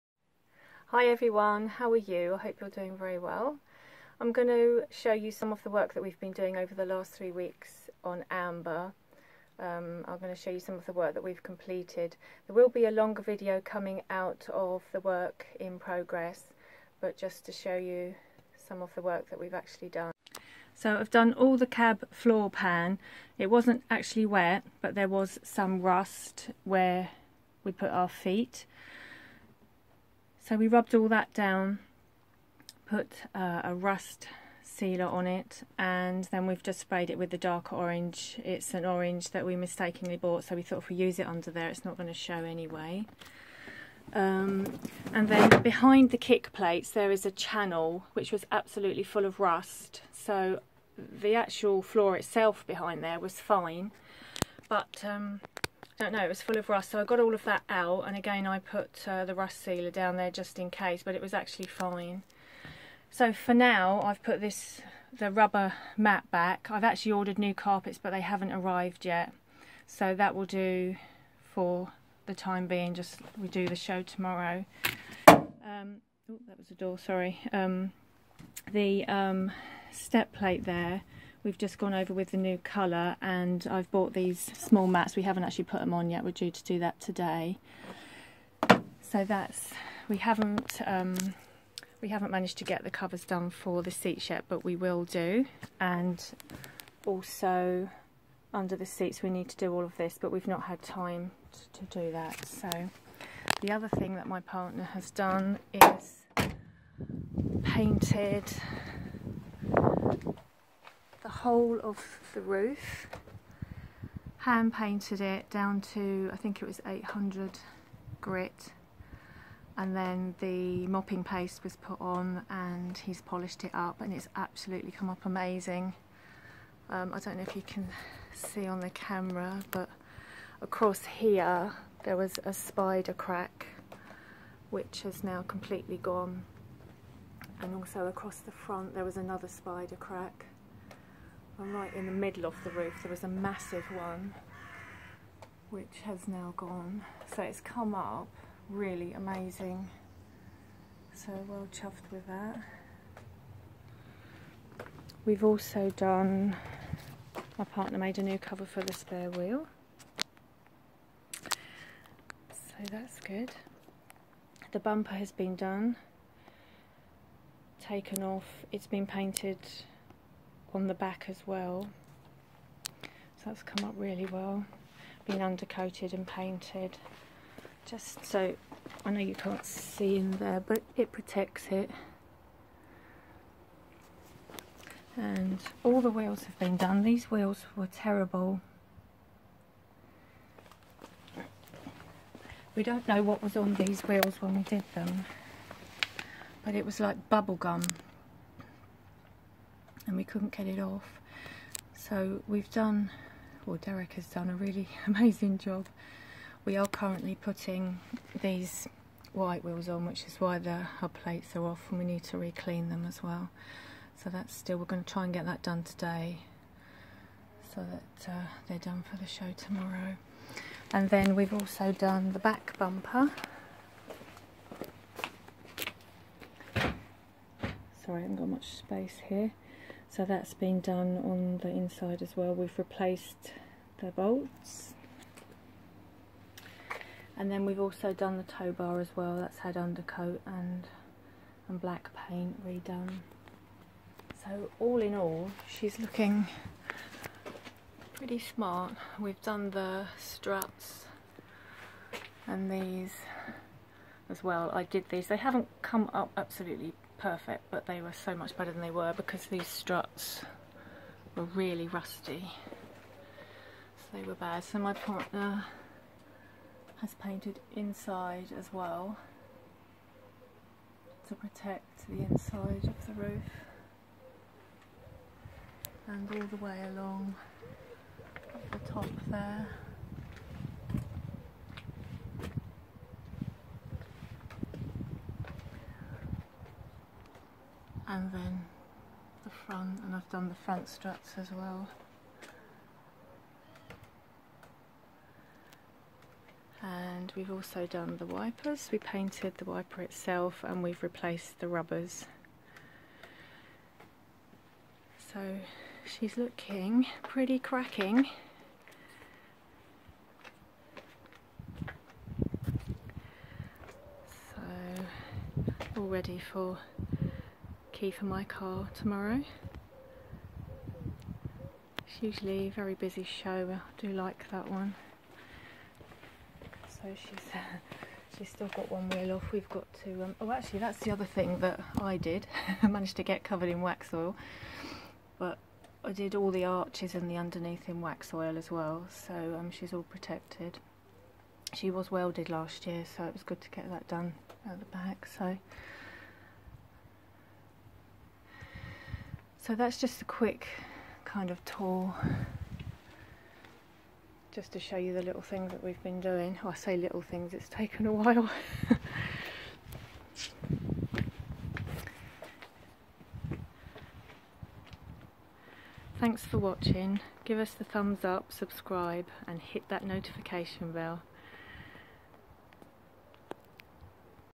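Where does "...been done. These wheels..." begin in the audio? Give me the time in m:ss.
3:06.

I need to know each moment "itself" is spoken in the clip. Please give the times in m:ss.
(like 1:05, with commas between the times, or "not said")
0:52, 5:00.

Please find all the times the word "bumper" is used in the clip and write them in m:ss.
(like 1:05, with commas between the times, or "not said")
2:44, 3:42.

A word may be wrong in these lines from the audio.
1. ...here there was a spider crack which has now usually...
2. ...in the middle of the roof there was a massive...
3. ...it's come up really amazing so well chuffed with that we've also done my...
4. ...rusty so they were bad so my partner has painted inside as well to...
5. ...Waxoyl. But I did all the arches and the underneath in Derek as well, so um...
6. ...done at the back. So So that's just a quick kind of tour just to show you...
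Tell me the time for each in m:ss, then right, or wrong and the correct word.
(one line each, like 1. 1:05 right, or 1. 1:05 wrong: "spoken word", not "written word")
1. 2:11 wrong: "completely", not "usually"
2. 2:21 right
3. 2:27 right
4. 4:21 right
5. 5:33 wrong: "Waxoyl", not "Derek"
6. 5:44 right.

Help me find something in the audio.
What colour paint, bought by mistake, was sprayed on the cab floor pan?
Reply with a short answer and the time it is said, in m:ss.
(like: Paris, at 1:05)
Dark orange, at 0:37.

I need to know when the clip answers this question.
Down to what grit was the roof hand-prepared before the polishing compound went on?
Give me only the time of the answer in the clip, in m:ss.
1:56.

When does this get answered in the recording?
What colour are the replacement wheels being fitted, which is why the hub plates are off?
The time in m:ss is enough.
3:29.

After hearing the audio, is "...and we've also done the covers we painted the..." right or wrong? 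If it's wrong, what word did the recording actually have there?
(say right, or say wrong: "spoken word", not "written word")
wrong: "wipers", not "covers".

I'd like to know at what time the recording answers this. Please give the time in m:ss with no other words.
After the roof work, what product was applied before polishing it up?
2:00.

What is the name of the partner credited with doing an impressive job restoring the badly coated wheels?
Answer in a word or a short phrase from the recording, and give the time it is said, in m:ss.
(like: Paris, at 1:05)
Derek, at 3:23.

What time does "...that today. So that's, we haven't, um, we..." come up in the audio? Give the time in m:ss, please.
1:26.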